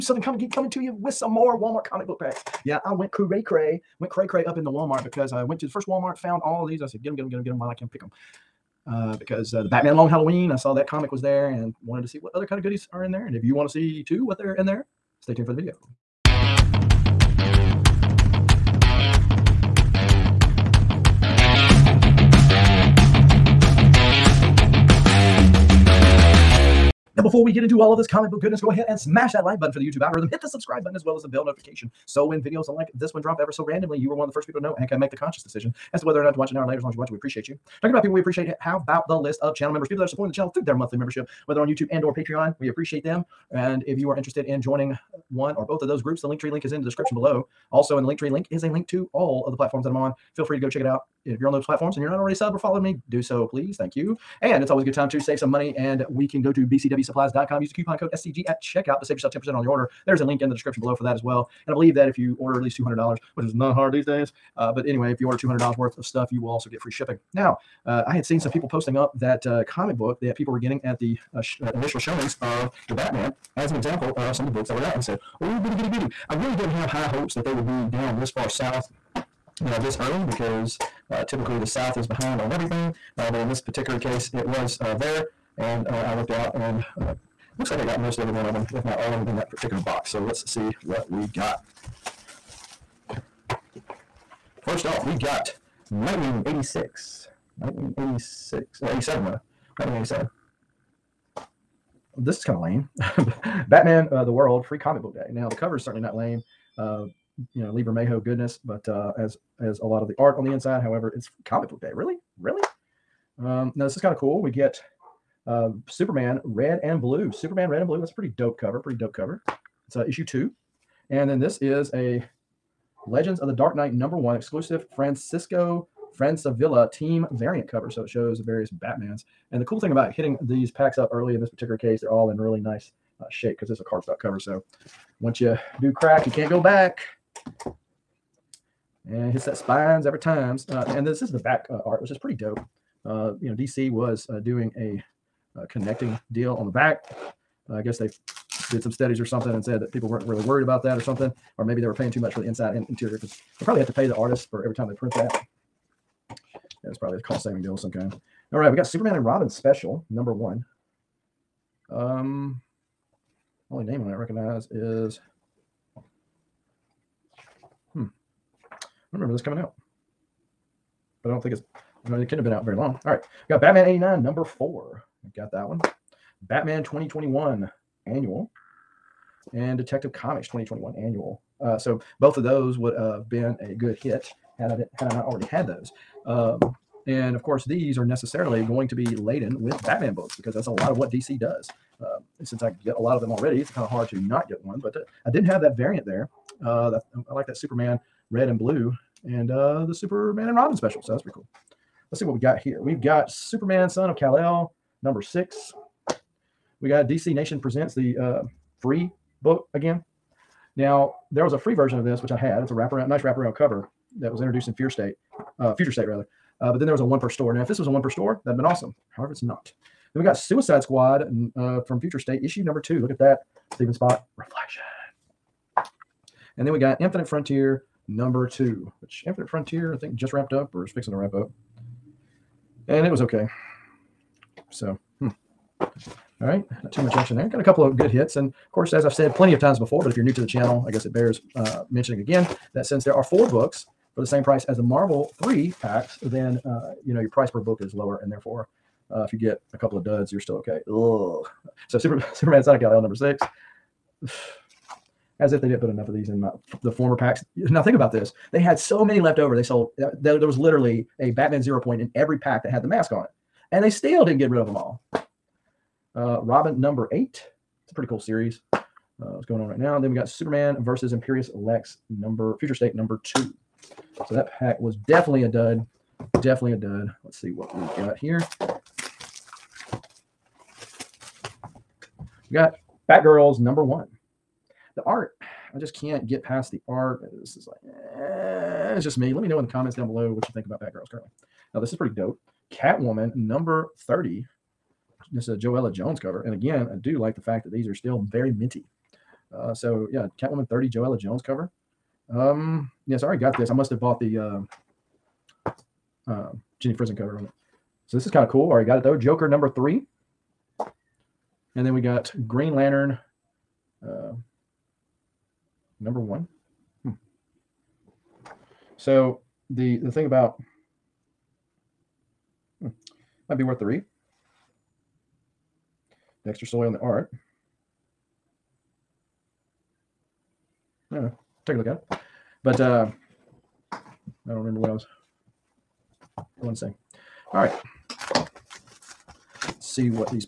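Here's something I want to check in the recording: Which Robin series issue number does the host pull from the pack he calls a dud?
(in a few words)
8.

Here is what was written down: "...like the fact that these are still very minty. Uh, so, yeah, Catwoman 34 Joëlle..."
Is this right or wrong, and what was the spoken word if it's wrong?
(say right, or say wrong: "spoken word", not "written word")
wrong: "30", not "34".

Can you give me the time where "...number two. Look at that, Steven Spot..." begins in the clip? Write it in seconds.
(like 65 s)
222 s.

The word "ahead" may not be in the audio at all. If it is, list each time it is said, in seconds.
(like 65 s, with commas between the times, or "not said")
28 s.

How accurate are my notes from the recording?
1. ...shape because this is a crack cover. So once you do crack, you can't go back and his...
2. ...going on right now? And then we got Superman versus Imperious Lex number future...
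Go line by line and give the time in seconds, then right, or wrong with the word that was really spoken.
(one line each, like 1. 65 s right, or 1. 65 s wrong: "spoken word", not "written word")
1. 133 s wrong: "cardstock", not "crack"
2. 269 s right.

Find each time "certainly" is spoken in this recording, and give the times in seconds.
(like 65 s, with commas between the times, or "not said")
105 s.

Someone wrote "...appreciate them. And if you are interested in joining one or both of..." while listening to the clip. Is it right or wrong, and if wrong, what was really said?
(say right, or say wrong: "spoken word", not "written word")
right.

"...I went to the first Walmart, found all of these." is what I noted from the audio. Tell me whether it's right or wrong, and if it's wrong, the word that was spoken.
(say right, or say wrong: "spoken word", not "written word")
right.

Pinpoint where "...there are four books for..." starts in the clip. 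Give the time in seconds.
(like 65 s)
243 s.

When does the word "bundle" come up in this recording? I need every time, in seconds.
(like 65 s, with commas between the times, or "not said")
not said.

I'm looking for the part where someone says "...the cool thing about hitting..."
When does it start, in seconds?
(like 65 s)
129 s.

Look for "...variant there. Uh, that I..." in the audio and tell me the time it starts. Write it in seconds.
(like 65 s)
195 s.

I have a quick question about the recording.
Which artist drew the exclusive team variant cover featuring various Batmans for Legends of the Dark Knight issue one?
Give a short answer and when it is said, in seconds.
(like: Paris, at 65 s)
Francisco Francavilla, at 124 s.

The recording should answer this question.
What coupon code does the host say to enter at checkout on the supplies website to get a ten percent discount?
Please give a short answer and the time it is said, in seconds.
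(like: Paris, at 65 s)
SCG, at 58 s.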